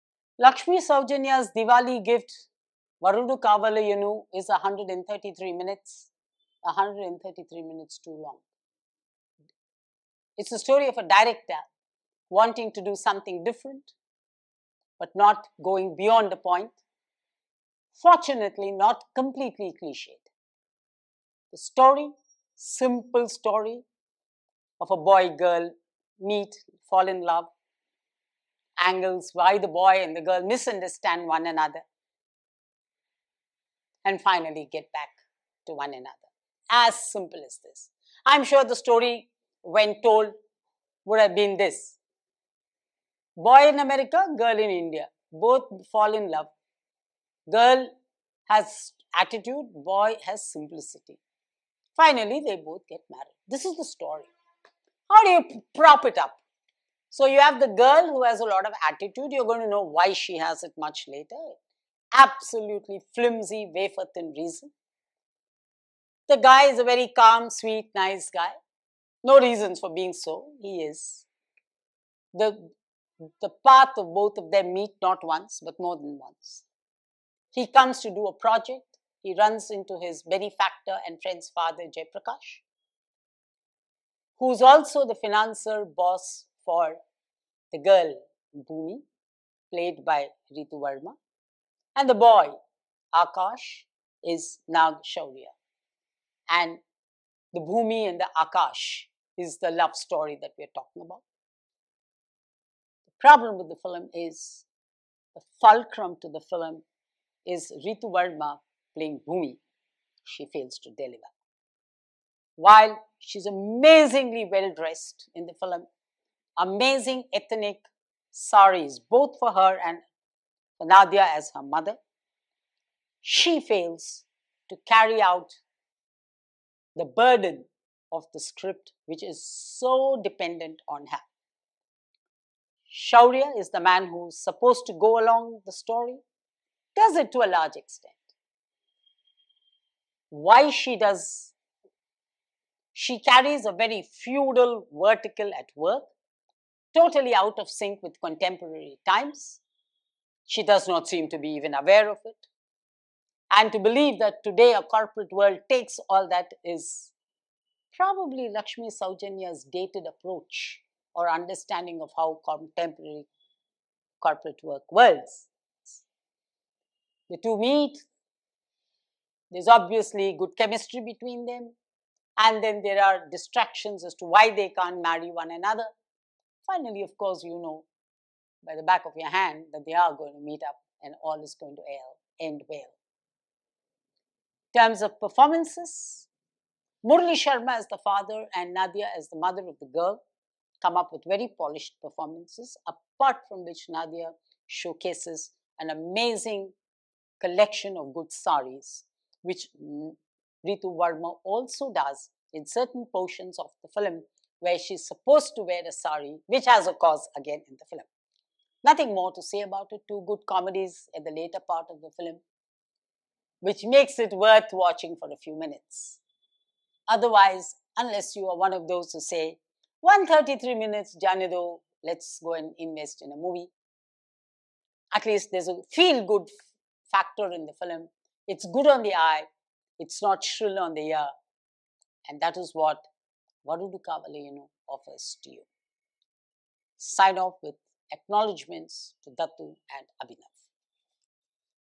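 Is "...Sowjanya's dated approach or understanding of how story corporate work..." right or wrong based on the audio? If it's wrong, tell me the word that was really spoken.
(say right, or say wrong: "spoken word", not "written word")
wrong: "contemporary", not "story".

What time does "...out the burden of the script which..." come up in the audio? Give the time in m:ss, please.
2:05.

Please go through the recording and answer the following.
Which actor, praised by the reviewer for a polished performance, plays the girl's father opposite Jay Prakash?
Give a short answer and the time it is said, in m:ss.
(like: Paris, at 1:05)
Murali Sharma, at 3:07.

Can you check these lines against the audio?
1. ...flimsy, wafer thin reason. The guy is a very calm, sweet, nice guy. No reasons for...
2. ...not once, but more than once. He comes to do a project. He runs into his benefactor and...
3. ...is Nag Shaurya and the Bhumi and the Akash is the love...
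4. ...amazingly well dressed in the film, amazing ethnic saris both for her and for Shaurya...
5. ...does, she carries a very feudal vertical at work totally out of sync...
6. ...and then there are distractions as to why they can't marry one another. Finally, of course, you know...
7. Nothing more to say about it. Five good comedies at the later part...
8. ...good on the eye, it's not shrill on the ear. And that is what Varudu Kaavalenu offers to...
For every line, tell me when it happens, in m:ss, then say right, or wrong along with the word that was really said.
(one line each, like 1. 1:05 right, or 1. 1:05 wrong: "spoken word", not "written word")
1. 1:03 right
2. 1:15 right
3. 1:34 right
4. 1:53 wrong: "Nadhiya", not "Shaurya"
5. 2:20 right
6. 2:52 right
7. 3:28 wrong: "Two", not "Five"
8. 3:48 right.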